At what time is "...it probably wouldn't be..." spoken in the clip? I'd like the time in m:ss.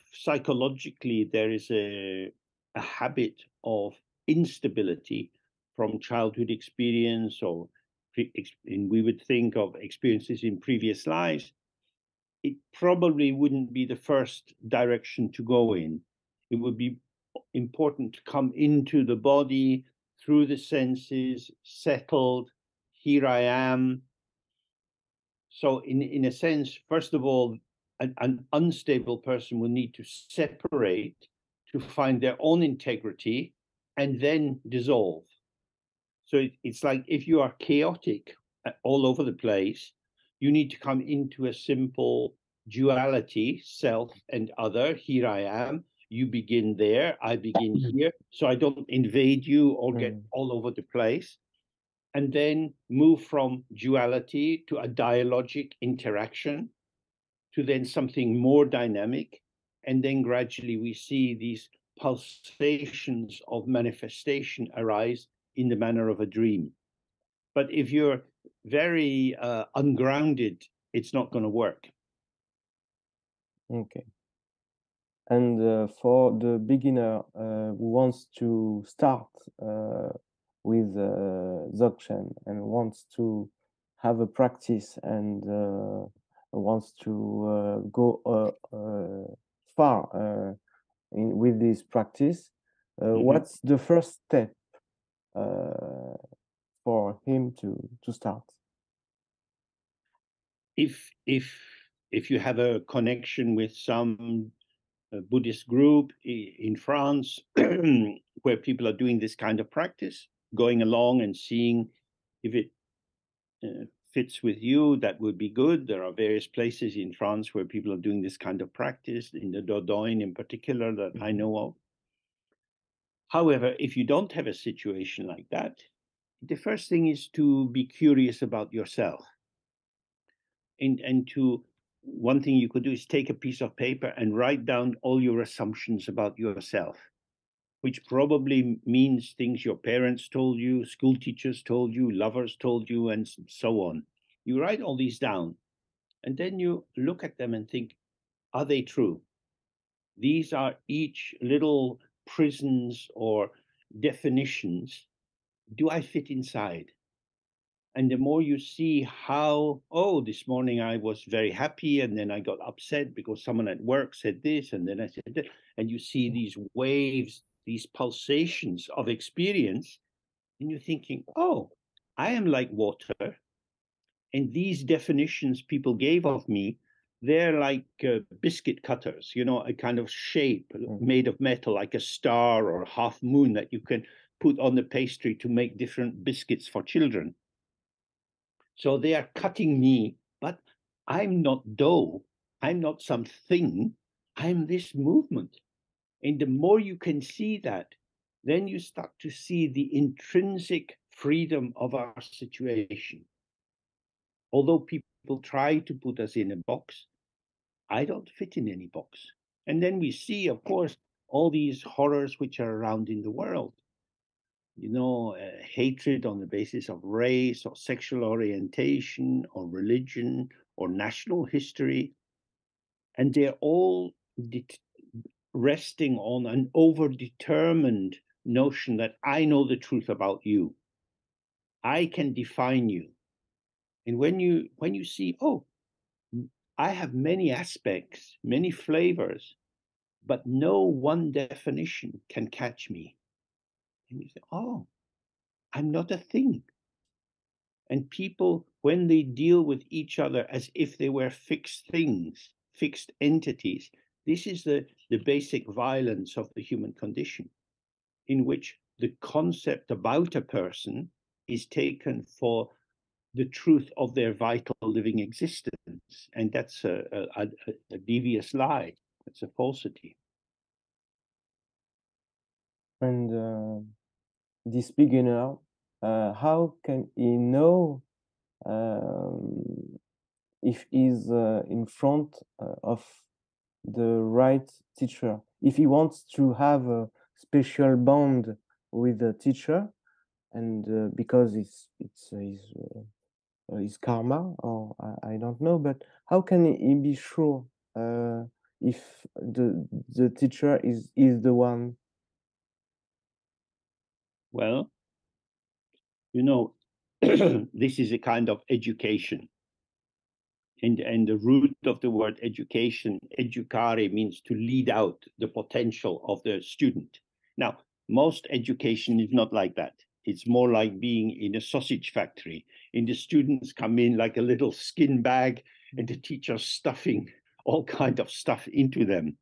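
0:12.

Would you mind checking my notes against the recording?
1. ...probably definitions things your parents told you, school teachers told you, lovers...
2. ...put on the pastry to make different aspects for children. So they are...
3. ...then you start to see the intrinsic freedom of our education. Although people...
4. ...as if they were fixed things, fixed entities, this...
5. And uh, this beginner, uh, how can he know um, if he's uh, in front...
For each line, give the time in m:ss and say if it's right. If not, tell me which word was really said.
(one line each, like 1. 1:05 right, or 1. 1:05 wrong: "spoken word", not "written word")
1. 2:18 wrong: "means", not "definitions"
2. 3:04 wrong: "biscuits", not "aspects"
3. 3:18 wrong: "situation", not "education"
4. 4:10 right
5. 4:32 right.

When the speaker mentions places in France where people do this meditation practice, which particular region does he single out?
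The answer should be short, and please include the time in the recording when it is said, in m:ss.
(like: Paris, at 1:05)
Dordogne, at 1:59.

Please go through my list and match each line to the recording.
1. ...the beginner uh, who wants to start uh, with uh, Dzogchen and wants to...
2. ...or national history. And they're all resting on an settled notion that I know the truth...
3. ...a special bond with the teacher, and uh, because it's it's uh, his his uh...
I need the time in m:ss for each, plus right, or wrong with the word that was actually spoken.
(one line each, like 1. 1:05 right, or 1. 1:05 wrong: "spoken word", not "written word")
1. 1:16 right
2. 3:40 wrong: "overdetermined", not "settled"
3. 4:46 right.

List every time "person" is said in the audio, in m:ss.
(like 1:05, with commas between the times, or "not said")
0:29, 4:20.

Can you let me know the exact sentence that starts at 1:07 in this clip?
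But if you're very uh, ungrounded, it's not going to work.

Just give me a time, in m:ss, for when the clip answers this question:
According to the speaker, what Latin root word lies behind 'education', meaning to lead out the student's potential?
5:13.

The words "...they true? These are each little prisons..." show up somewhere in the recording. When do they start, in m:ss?
2:28.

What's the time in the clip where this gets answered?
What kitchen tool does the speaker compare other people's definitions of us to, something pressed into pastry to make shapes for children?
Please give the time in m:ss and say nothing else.
2:58.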